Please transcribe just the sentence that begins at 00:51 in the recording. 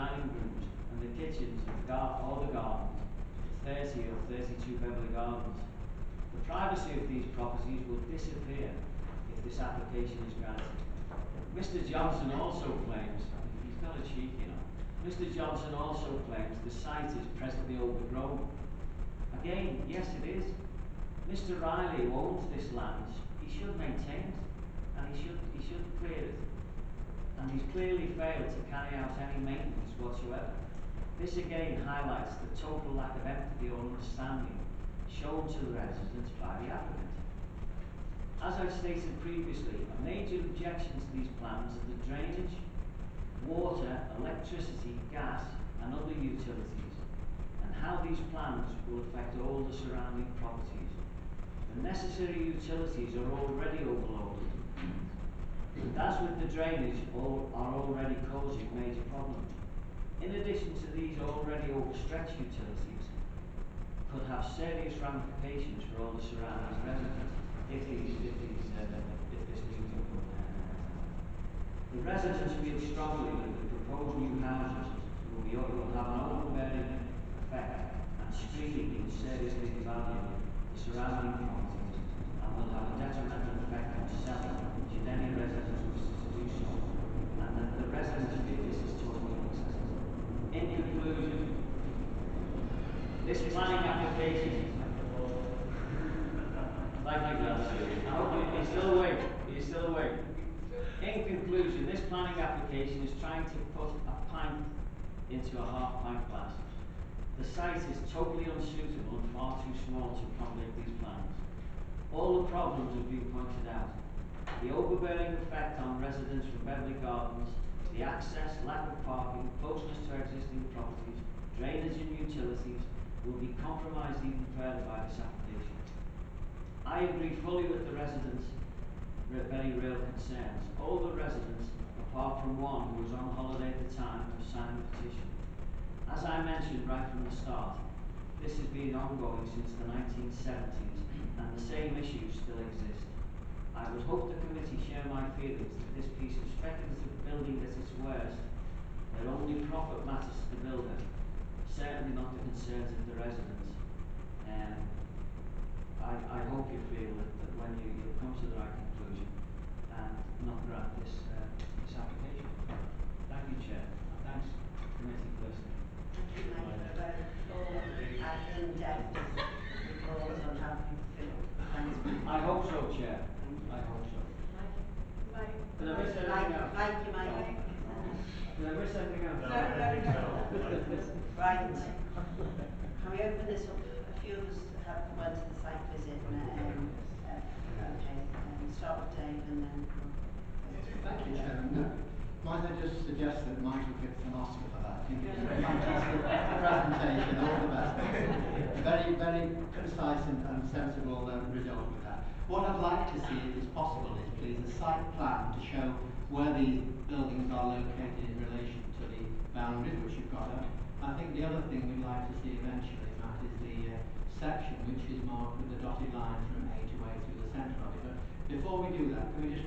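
The necessary utilities are already overloaded, and as with the drainage, all are already causing major problems.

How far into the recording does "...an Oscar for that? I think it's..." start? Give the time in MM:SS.
03:14.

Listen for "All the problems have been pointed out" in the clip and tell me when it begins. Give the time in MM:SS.
01:52.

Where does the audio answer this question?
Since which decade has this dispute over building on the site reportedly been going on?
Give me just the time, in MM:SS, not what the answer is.
02:19.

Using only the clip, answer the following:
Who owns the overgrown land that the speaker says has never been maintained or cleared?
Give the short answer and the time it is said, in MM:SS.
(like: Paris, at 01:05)
Mr Riley, at 00:21.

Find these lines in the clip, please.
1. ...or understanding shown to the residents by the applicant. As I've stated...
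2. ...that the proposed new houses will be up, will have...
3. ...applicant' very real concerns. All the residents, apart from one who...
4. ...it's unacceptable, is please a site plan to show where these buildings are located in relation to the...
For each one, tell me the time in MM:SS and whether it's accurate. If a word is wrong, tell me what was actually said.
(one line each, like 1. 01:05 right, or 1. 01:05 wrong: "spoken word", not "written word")
1. 00:33 right
2. 01:13 right
3. 02:07 wrong: "residents", not "applicant"
4. 03:23 wrong: "possible", not "unacceptable".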